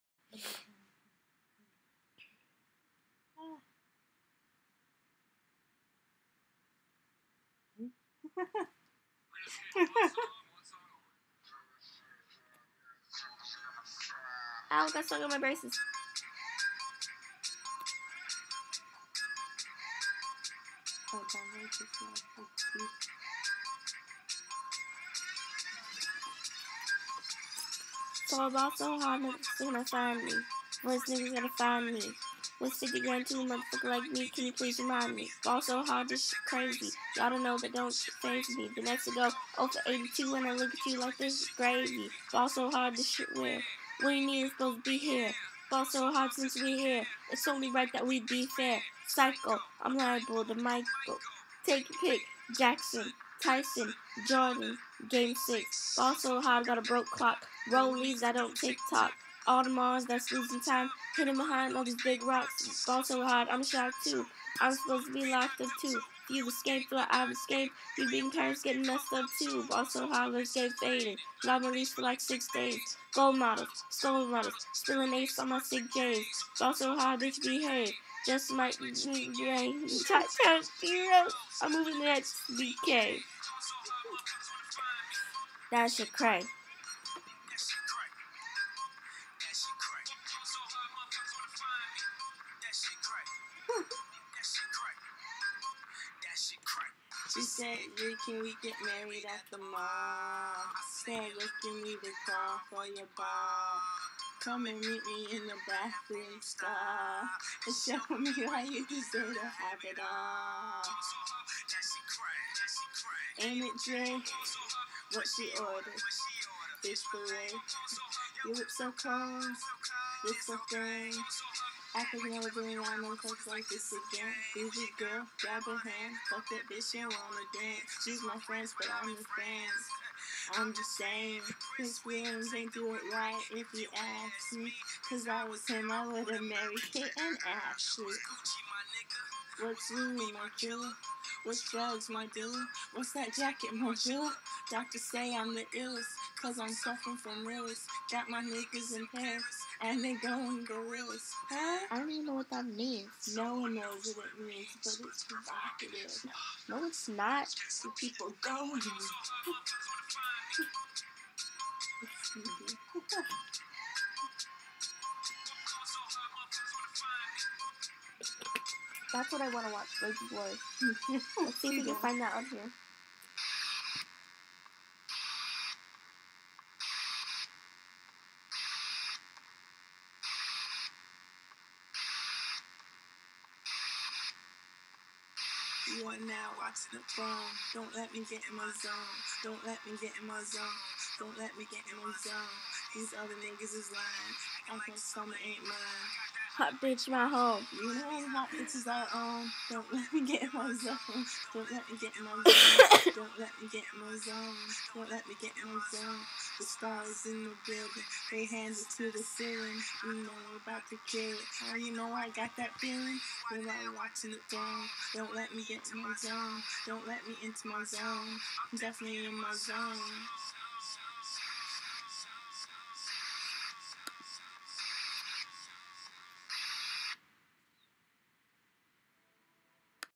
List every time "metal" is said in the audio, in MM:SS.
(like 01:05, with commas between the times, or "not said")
not said.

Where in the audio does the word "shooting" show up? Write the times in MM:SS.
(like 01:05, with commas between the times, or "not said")
not said.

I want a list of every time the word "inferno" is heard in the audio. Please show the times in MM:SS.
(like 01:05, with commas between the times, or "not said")
not said.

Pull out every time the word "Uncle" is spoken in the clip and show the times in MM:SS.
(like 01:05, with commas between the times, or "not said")
03:14.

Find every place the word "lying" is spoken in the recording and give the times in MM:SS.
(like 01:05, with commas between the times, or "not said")
03:13.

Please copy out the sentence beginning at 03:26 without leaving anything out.
The stars in the building, they hand it to the ceiling.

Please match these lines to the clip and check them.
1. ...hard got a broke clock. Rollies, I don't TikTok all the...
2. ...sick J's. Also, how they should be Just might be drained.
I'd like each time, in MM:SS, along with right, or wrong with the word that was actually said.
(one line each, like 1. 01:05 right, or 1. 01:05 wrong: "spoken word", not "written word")
1. 00:56 right
2. 01:15 right.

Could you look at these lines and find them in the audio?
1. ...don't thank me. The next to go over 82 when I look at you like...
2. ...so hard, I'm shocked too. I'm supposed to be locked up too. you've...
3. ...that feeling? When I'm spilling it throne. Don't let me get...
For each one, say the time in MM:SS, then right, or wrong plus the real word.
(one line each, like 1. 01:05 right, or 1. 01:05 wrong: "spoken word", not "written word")
1. 00:37 right
2. 01:03 right
3. 03:32 wrong: "watching", not "spilling".